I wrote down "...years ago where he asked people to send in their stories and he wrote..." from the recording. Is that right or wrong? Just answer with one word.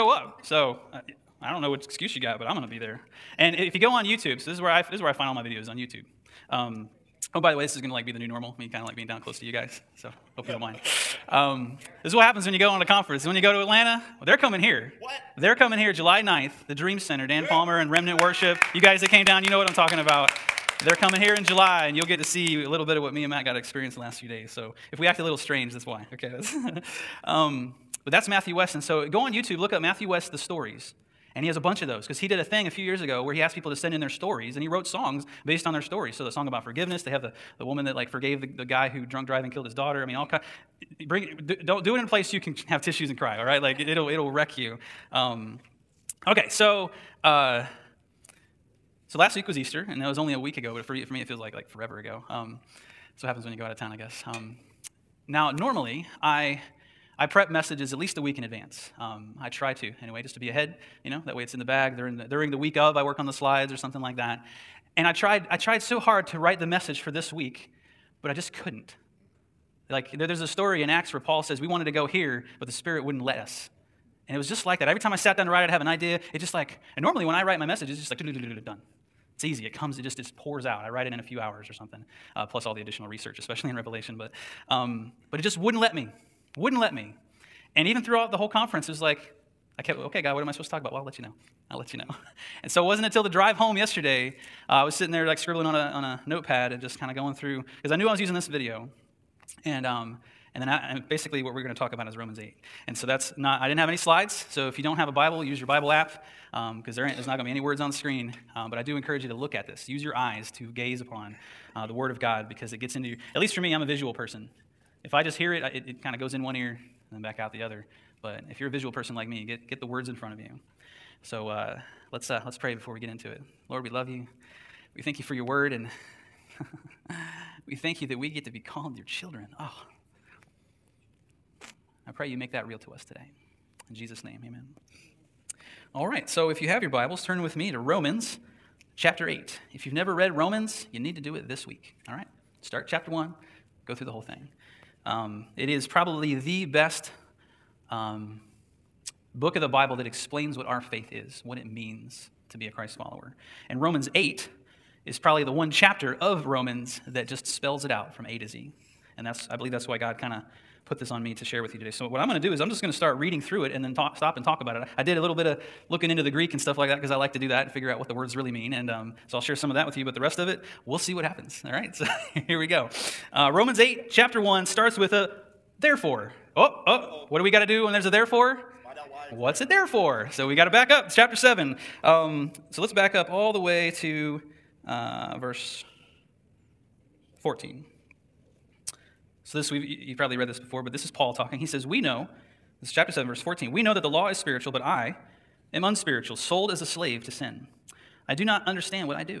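right.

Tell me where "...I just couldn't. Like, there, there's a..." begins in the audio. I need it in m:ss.
1:08.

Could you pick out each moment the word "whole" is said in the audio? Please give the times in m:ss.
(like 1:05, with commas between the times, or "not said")
1:28, 2:24.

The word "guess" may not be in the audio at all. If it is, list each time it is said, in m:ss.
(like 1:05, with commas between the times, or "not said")
0:53.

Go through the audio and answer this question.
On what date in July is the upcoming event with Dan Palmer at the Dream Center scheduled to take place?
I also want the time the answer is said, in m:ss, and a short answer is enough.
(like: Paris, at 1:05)
July 9, at 0:15.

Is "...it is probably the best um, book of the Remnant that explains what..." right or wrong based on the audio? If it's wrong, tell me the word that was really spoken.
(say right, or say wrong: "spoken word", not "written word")
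wrong: "Bible", not "Remnant".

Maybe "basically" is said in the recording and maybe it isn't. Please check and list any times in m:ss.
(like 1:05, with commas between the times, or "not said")
1:41.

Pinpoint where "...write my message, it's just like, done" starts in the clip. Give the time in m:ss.
1:17.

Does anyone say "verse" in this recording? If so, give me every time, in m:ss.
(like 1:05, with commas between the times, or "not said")
3:05, 3:13.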